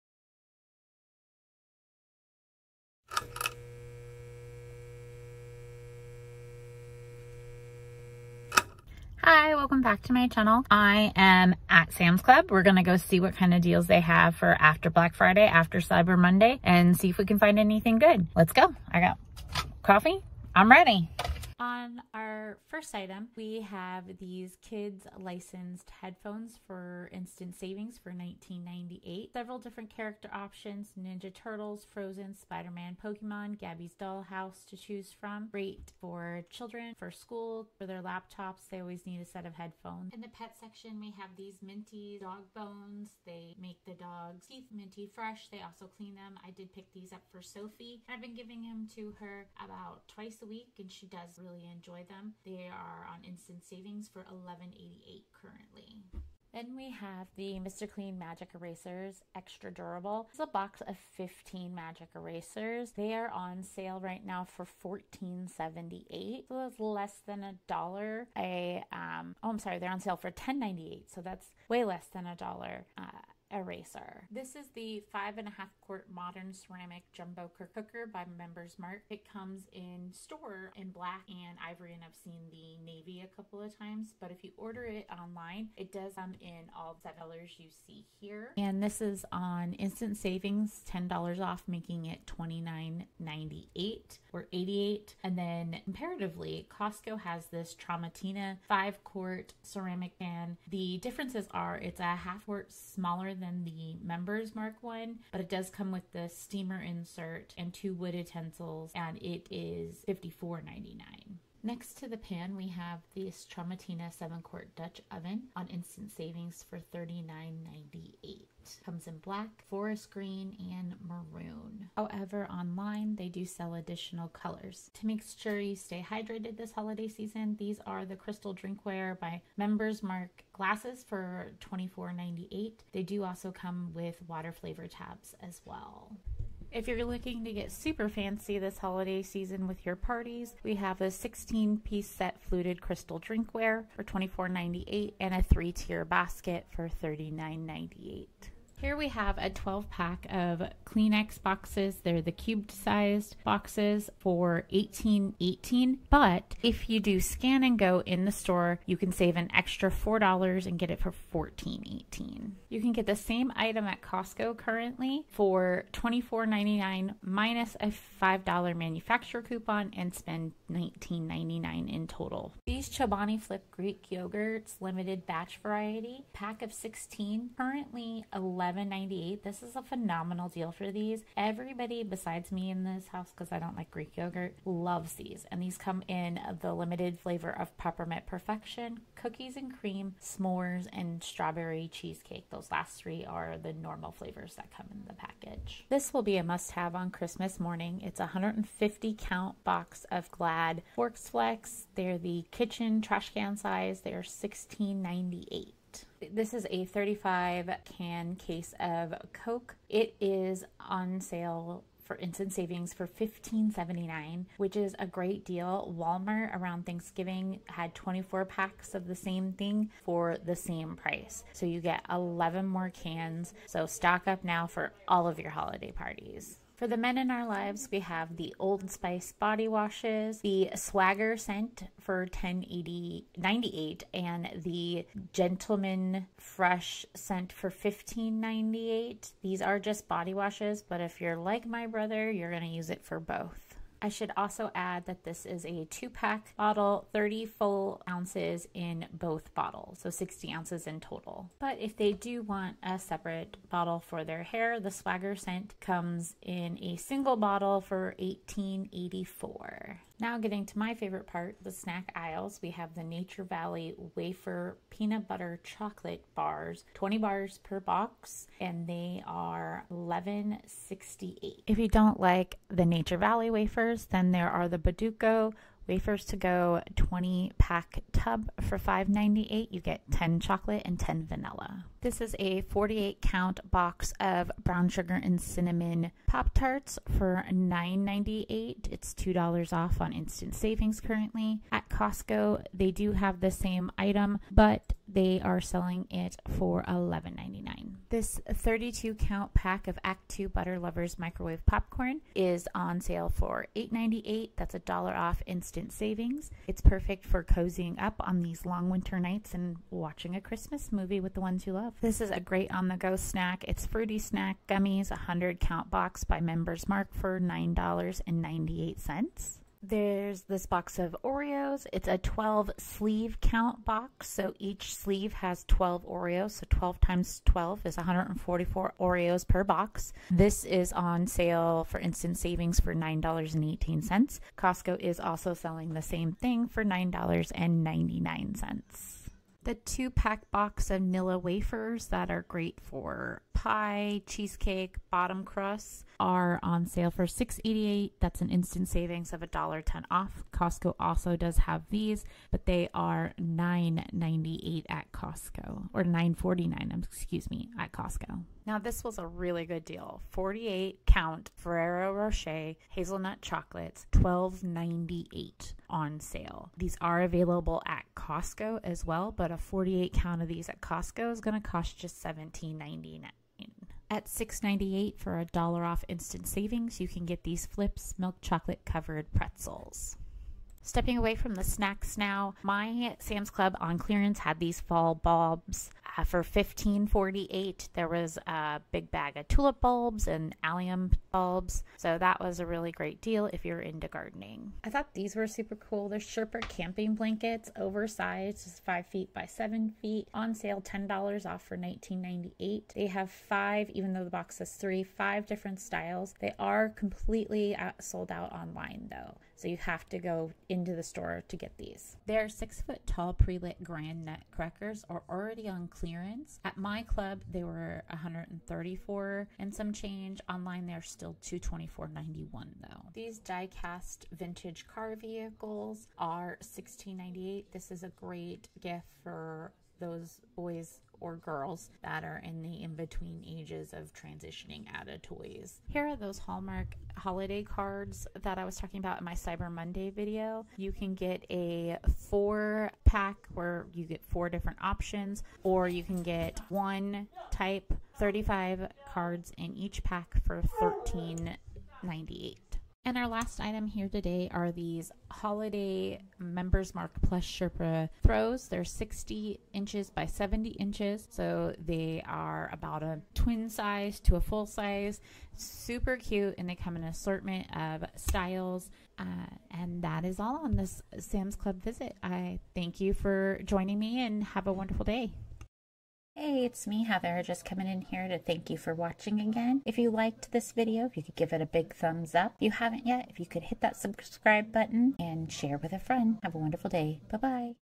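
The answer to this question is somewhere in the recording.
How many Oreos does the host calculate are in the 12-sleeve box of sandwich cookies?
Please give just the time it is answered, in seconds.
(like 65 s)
327 s.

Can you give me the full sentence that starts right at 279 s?
You get 10 chocolate and 10 vanilla.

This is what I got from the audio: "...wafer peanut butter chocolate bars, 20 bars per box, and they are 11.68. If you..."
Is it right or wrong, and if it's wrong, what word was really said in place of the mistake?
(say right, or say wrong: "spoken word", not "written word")
right.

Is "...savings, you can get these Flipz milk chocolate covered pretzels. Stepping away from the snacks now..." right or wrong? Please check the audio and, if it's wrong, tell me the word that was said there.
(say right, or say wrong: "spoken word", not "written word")
right.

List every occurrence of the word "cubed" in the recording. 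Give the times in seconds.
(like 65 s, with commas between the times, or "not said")
152 s.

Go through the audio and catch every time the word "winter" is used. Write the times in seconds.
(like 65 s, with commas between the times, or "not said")
308 s.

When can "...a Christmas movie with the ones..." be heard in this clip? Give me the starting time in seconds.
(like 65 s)
310 s.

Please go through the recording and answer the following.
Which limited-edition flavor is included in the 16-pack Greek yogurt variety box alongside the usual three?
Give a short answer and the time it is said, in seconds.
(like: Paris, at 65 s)
Peppermint Perfection, at 187 s.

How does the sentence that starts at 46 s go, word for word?
I did pick these up for Sophie.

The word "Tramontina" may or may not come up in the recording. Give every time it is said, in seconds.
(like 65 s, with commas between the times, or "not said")
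97 s, 113 s.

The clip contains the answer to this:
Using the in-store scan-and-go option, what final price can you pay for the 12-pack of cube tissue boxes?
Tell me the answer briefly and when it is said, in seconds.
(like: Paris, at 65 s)
$14.18, at 161 s.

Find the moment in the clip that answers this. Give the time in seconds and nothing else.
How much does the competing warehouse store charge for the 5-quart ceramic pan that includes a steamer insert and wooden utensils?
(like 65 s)
110 s.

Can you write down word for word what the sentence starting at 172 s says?
These Chobani Flip Greek yogurts limited batch variety pack of 16 currently 11 $11.98.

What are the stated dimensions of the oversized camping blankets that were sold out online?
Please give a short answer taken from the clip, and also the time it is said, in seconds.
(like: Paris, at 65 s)
5 feet by 7 feet, at 398 s.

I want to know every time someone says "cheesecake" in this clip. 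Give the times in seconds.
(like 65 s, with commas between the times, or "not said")
191 s, 344 s.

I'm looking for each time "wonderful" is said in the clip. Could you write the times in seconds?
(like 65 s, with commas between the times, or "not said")
474 s, 486 s.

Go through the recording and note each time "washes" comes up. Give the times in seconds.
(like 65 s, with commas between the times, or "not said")
229 s, 240 s.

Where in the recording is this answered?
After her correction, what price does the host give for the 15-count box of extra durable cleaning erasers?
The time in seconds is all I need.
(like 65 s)
70 s.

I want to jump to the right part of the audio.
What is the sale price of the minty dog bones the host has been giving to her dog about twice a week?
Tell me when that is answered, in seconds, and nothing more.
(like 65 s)
54 s.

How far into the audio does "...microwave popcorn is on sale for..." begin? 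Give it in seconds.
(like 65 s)
301 s.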